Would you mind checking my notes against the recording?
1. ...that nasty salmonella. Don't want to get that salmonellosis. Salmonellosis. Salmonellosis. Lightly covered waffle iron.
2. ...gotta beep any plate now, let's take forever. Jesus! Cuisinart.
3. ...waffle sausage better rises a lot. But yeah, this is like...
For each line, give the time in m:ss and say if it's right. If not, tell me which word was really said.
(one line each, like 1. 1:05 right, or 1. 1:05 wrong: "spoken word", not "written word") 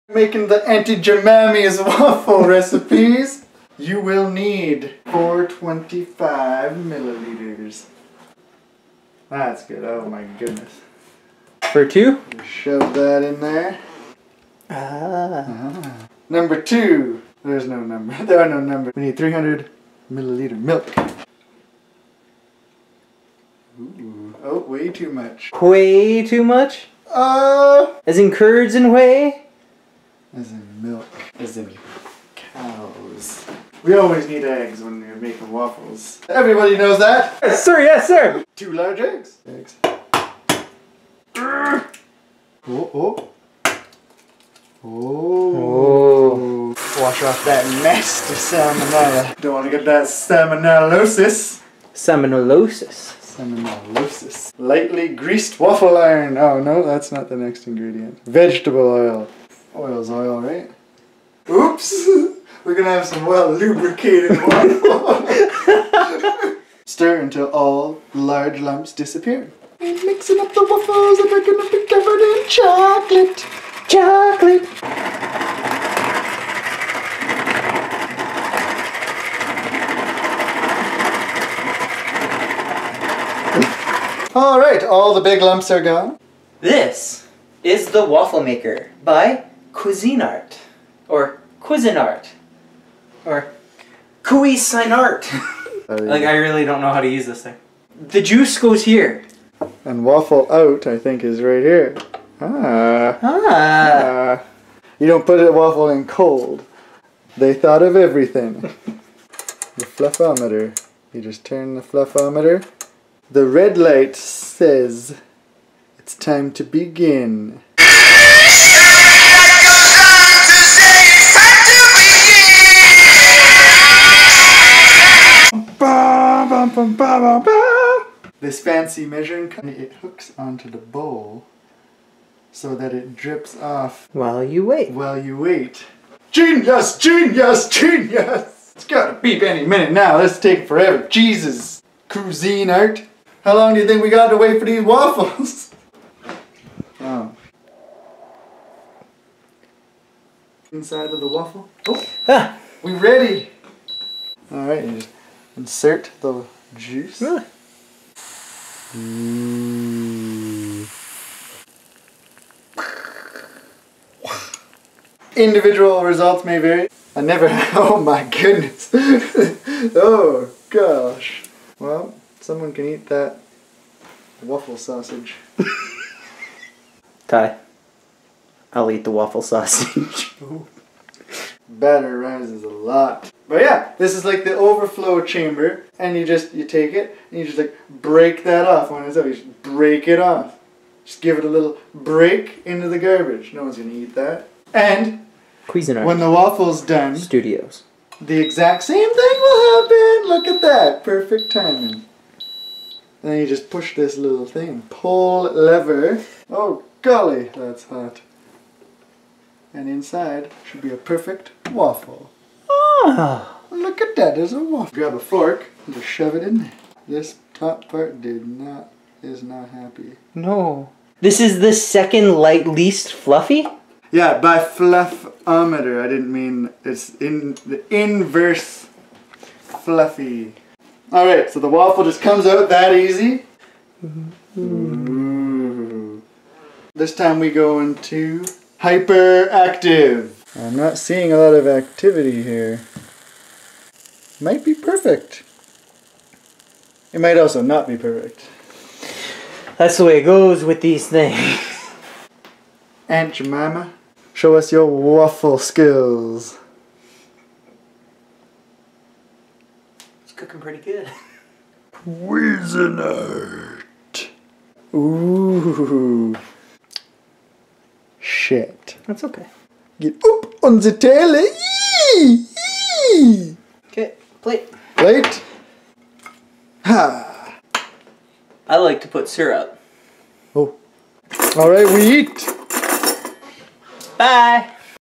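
1. 0:47 wrong: "greased", not "covered"
2. 2:18 wrong: "minute", not "plate"
3. 2:59 right.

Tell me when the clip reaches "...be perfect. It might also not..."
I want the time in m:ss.
4:04.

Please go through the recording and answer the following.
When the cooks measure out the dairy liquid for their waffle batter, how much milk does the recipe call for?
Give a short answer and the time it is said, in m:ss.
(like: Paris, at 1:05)
300 milliliters, at 0:19.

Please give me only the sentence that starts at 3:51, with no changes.
All right, so the waffle just comes out that easy.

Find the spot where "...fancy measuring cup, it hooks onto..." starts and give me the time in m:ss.
2:08.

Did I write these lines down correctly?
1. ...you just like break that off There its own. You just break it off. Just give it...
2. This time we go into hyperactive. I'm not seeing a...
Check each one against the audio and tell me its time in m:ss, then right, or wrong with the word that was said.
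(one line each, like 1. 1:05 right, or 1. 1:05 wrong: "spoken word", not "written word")
1. 3:07 wrong: "When", not "There"
2. 3:56 right.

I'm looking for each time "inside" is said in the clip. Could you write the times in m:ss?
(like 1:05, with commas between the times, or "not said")
2:30, 3:29.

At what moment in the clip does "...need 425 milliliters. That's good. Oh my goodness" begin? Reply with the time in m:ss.
0:04.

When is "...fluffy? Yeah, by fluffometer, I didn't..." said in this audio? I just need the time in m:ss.
3:43.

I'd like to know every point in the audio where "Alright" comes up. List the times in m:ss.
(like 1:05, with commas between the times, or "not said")
1:24, 2:34.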